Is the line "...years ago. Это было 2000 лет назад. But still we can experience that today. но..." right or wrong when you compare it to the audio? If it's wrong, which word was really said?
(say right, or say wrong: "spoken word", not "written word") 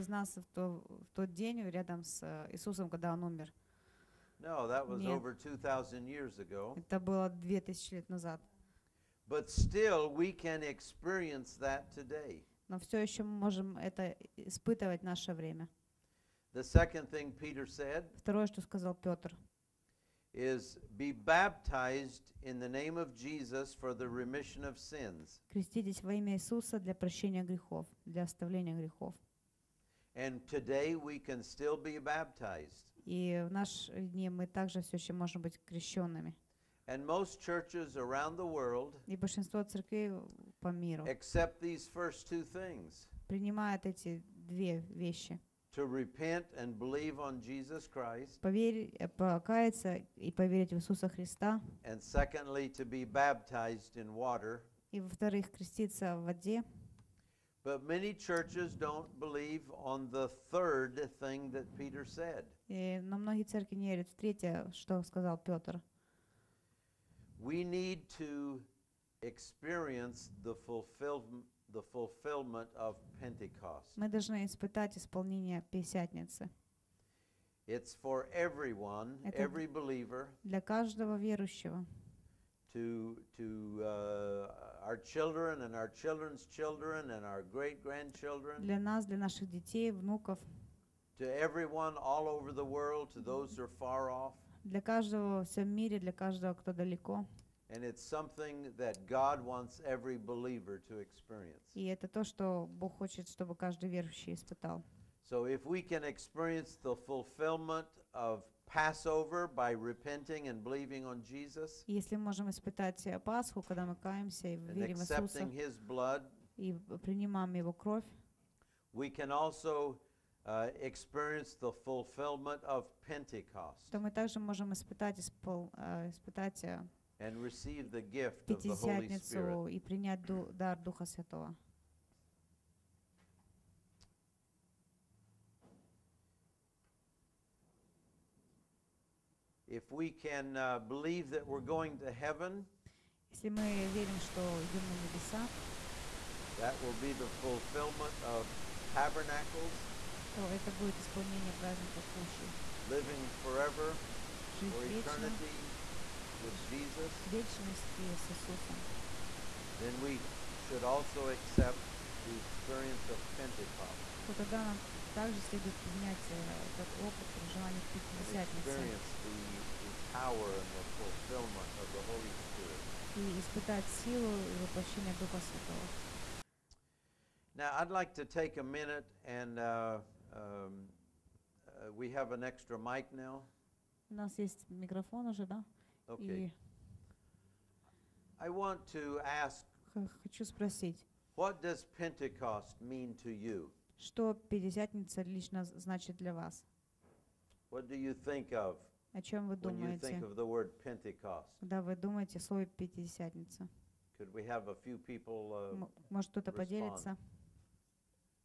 right.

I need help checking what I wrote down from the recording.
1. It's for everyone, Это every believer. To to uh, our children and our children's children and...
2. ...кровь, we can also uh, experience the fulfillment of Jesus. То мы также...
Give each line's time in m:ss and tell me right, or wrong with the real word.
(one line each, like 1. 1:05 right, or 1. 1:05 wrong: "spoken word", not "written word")
1. 1:17 right
2. 1:57 wrong: "Pentecost", not "Jesus".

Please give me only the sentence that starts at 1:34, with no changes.
Для каждого в всем мире, для каждого, кто далеко.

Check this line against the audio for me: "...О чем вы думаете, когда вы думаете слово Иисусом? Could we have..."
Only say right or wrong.
wrong.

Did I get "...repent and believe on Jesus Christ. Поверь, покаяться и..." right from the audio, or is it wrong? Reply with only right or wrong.
right.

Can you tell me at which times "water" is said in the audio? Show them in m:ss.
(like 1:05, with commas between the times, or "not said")
0:54.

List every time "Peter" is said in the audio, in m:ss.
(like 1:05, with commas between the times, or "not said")
0:17, 1:01.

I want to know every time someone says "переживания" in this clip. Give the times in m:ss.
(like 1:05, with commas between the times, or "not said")
2:47.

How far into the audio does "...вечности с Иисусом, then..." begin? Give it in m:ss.
2:37.